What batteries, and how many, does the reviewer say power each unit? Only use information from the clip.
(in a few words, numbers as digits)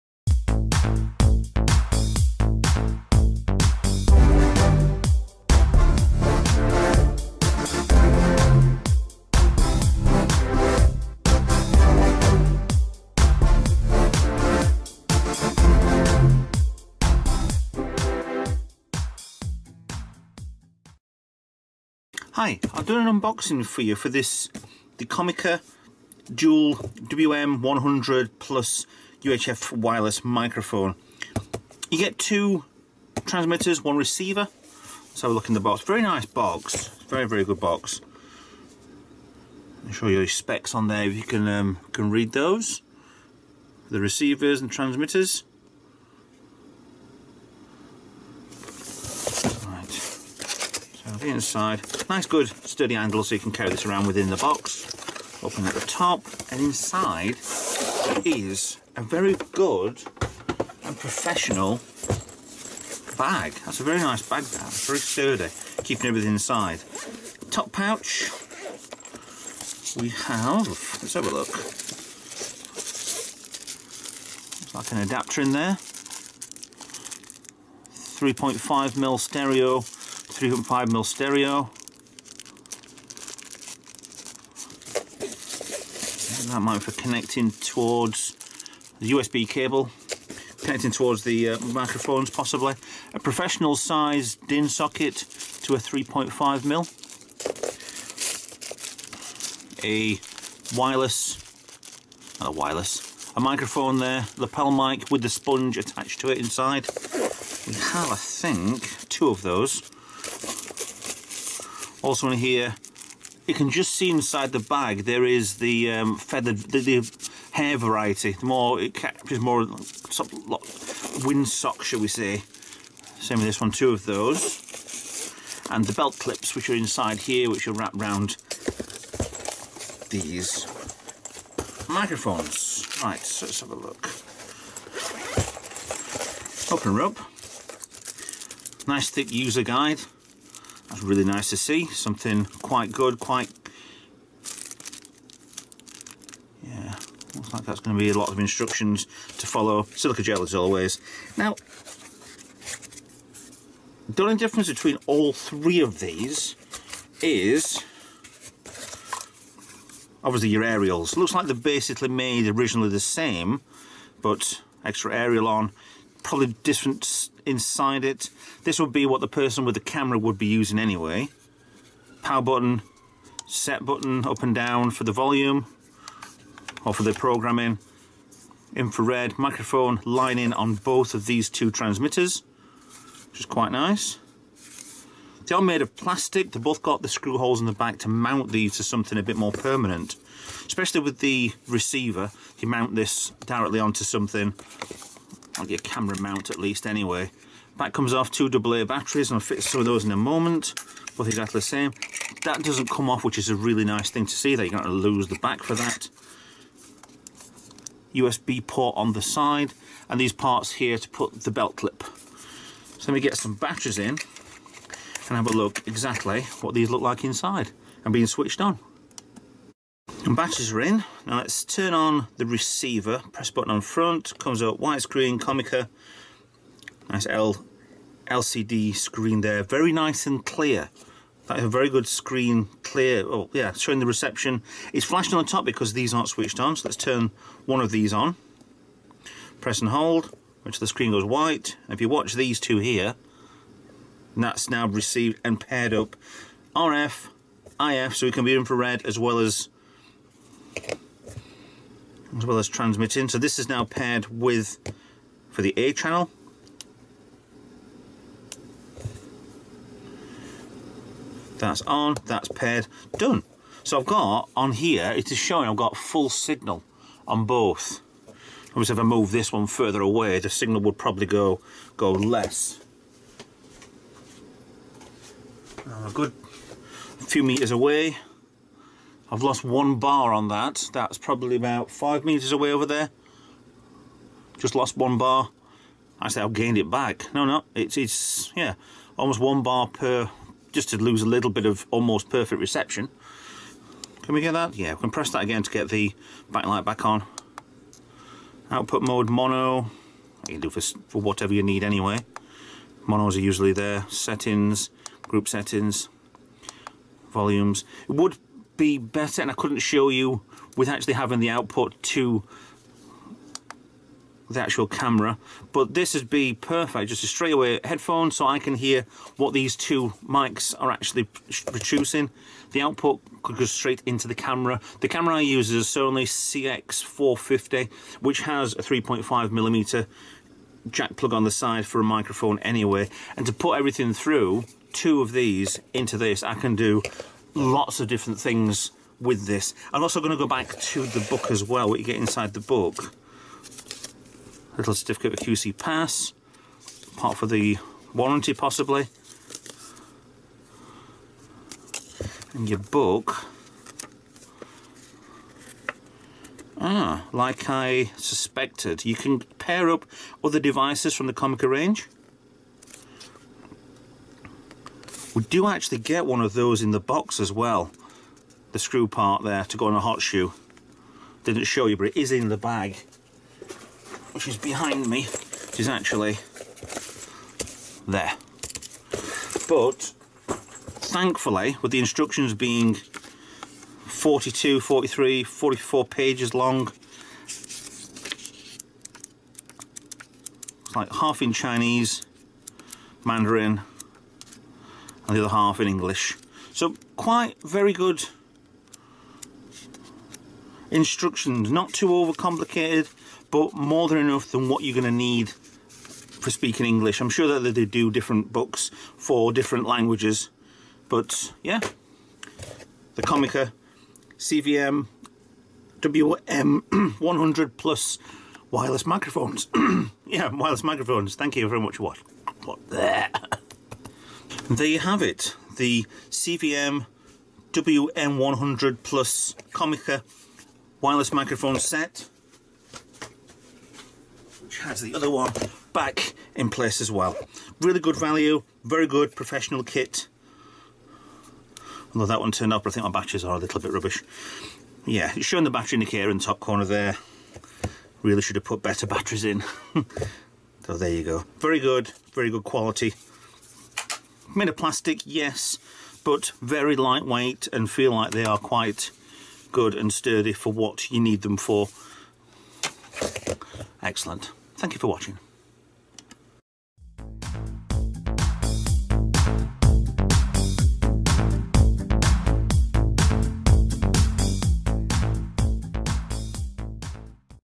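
2 AA.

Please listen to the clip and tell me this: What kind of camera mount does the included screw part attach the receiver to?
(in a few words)
Hot shoe.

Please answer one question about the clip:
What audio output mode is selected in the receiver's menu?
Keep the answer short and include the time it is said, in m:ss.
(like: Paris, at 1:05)
Mono, at 4:59.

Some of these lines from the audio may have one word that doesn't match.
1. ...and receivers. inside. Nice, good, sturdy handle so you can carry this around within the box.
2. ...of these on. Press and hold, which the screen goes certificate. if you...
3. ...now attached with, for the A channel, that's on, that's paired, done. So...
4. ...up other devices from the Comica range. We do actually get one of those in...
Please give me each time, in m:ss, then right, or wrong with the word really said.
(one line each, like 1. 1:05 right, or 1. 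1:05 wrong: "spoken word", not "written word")
1. 0:44 wrong: "transmitters", not "receivers"
2. 3:57 wrong: "white", not "certificate"
3. 4:13 wrong: "paired", not "attached"
4. 5:59 right.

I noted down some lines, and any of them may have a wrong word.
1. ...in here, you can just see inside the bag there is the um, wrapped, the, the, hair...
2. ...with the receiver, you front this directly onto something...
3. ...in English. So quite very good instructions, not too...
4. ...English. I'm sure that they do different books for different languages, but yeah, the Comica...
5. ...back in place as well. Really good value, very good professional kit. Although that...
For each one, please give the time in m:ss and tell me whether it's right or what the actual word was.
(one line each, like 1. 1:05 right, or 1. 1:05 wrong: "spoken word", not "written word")
1. 1:52 wrong: "feathered", not "wrapped"
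2. 3:11 wrong: "mount", not "front"
3. 6:35 right
4. 6:46 right
5. 7:15 right.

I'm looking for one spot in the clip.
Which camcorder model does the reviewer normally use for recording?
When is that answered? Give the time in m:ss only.
5:25.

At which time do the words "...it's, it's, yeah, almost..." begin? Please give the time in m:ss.
4:47.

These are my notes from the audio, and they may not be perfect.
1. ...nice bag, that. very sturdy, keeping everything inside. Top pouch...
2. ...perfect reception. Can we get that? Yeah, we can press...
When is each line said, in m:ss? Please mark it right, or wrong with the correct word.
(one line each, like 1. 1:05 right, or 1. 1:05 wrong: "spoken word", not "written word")
1. 1:03 right
2. 4:52 right.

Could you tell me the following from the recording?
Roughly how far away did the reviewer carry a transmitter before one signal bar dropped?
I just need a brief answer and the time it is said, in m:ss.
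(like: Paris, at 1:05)
5 meters, at 4:41.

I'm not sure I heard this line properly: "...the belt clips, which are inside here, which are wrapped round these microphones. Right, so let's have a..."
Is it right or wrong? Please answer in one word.
right.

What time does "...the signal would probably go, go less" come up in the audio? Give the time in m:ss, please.
4:30.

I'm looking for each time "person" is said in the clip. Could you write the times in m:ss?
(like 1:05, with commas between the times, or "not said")
2:49.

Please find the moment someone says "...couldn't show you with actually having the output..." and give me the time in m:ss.
5:09.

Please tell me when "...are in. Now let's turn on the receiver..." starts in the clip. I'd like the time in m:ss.
3:40.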